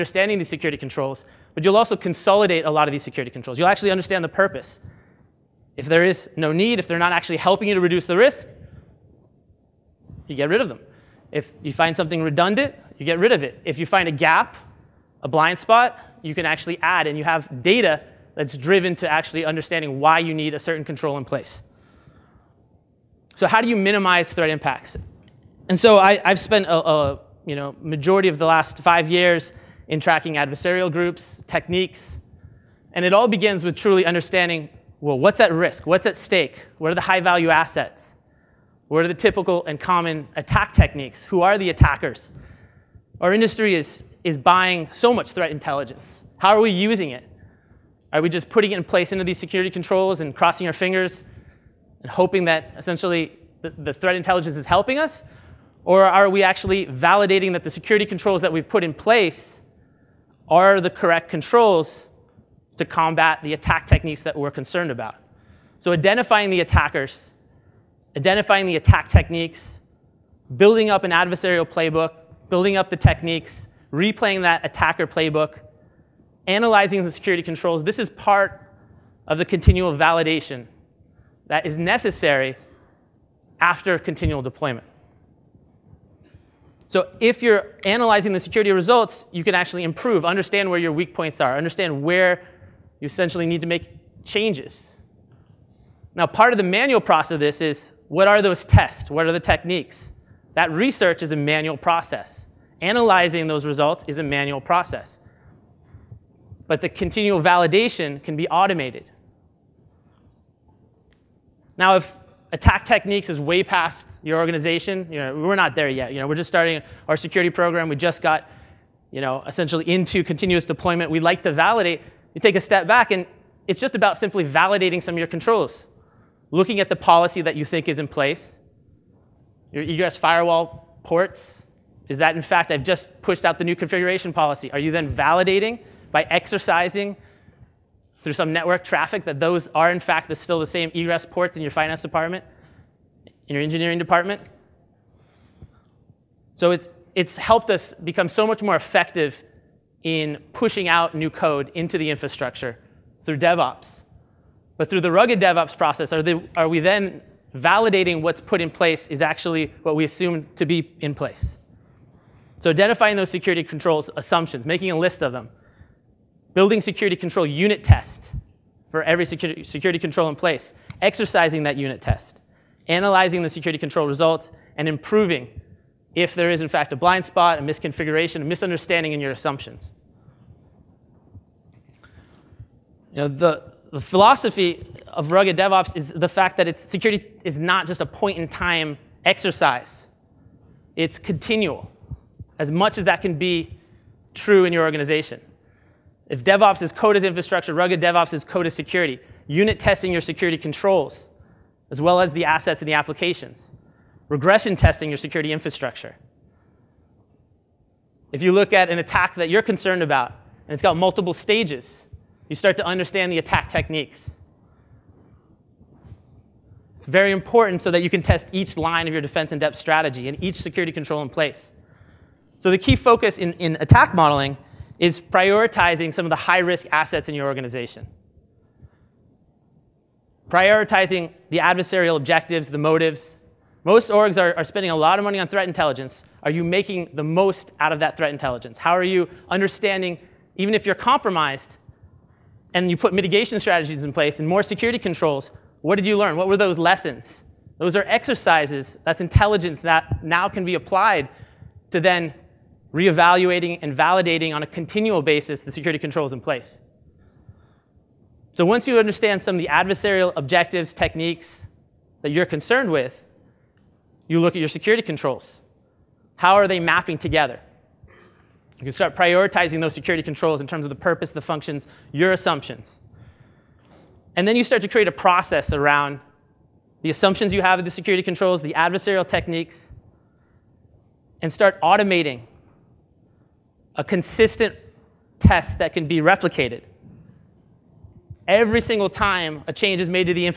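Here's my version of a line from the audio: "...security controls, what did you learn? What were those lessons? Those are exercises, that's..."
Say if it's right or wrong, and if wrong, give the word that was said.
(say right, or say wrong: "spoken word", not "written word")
right.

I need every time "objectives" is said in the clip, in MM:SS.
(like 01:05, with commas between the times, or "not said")
03:52, 04:20.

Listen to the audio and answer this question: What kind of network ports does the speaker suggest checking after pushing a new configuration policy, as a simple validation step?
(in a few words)
egress firewall ports.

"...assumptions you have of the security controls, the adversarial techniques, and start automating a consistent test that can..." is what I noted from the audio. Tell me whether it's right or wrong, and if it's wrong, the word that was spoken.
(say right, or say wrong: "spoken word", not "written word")
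right.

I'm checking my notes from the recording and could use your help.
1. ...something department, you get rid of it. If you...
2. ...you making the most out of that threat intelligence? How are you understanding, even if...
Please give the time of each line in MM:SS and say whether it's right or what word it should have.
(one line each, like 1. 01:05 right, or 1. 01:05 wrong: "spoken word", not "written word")
1. 00:11 wrong: "redundant", not "department"
2. 03:56 right.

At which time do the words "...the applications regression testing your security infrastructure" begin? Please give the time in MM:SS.
03:22.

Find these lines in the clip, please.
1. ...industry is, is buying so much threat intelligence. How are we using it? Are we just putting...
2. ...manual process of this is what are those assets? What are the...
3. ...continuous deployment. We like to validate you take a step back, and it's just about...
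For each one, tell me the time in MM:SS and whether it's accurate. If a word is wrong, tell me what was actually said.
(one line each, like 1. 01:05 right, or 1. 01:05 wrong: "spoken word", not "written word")
1. 00:43 right
2. 01:36 wrong: "tests", not "assets"
3. 02:00 right.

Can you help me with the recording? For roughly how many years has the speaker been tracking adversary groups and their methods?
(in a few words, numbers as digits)
5.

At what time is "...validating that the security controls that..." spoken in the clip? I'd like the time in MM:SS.
00:56.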